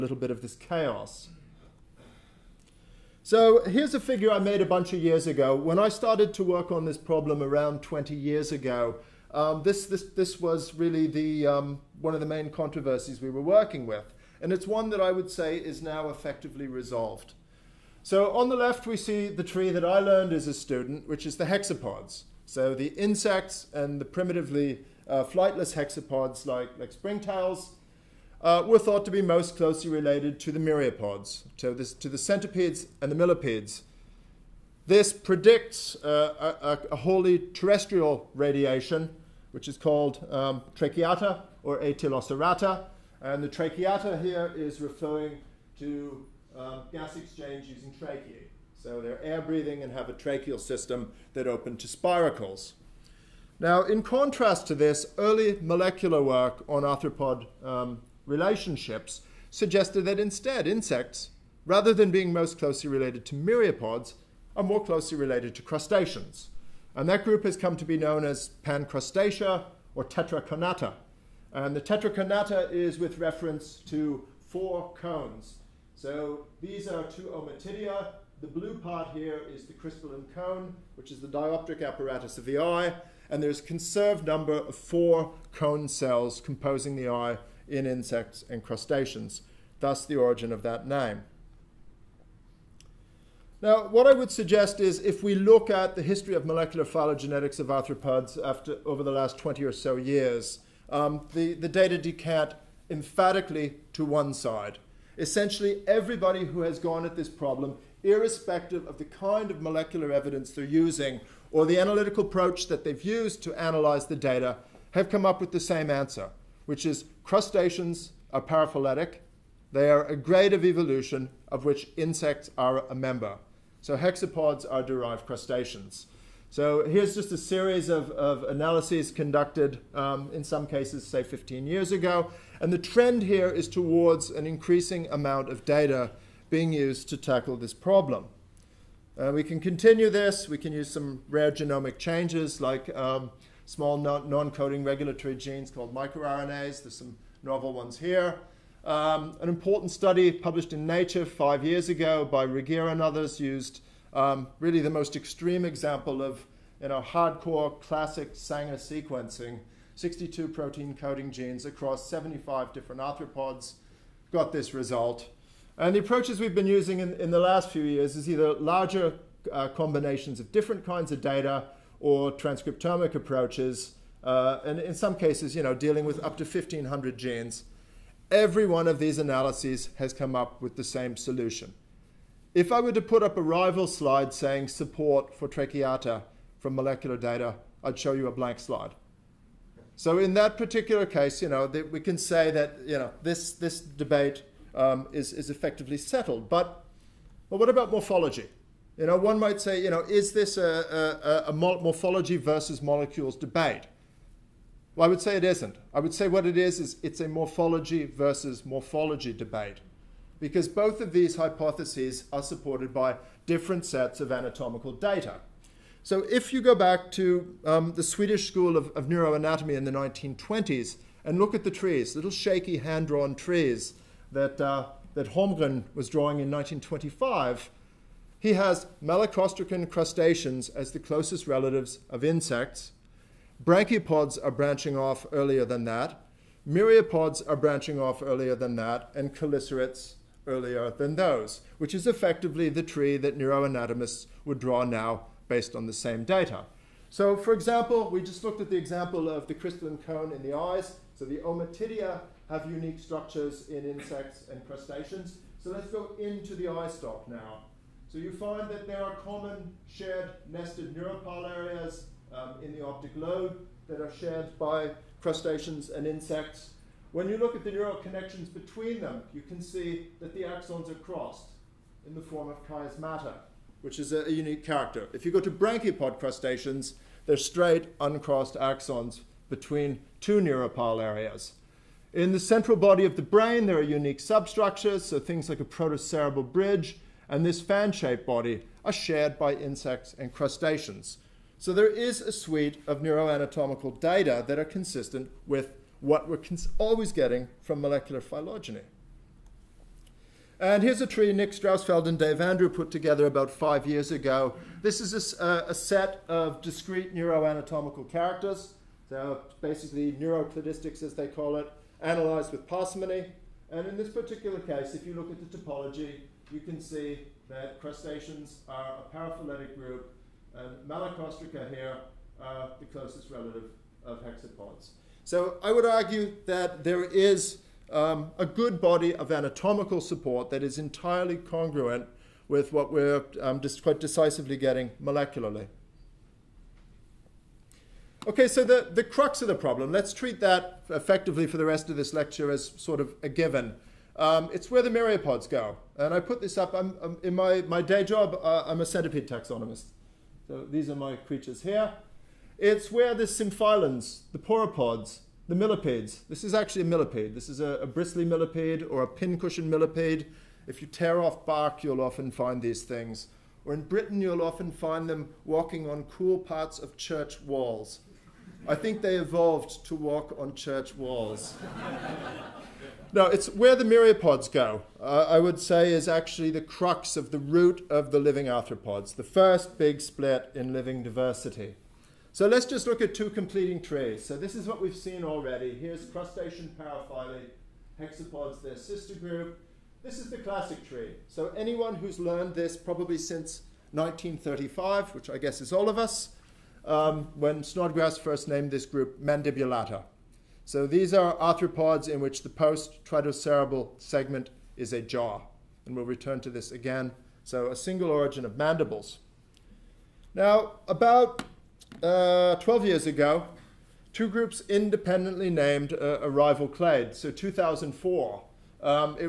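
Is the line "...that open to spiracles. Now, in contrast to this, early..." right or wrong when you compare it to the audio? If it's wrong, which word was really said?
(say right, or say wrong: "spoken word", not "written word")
right.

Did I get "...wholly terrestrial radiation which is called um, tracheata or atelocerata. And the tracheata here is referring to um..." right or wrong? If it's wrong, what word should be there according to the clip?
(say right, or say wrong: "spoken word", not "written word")
right.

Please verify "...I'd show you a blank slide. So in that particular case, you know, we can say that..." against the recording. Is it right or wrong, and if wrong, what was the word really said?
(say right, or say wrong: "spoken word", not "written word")
right.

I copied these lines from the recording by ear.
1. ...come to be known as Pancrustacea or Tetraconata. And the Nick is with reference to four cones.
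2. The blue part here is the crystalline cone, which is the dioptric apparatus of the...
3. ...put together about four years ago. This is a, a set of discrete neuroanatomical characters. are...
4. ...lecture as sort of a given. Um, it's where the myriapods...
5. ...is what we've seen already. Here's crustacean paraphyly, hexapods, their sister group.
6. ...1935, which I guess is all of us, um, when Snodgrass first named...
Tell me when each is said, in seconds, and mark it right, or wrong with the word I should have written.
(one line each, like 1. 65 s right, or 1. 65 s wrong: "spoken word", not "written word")
1. 67 s wrong: "Tetraconata", not "Nick"
2. 78 s right
3. 302 s wrong: "five", not "four"
4. 342 s right
5. 384 s right
6. 393 s right.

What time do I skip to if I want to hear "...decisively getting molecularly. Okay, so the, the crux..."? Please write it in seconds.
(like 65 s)
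333 s.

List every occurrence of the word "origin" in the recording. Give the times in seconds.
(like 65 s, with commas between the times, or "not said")
90 s, 408 s.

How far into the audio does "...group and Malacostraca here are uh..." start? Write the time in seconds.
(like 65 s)
319 s.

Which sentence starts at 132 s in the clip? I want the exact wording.
And the trend here is towards an increasing amount of data being used to tackle this problem.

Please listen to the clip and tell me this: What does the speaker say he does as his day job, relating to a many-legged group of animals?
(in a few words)
centipede taxonomist.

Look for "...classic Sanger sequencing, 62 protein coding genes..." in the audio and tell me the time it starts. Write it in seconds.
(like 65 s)
157 s.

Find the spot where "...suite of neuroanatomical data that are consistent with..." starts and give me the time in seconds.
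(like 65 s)
292 s.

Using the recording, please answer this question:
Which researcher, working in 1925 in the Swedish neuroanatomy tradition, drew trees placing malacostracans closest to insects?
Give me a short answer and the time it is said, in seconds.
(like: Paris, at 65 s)
Holmgren, at 225 s.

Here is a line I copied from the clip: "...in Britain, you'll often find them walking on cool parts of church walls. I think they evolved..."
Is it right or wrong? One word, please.
right.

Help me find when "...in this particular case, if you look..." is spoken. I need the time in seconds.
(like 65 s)
313 s.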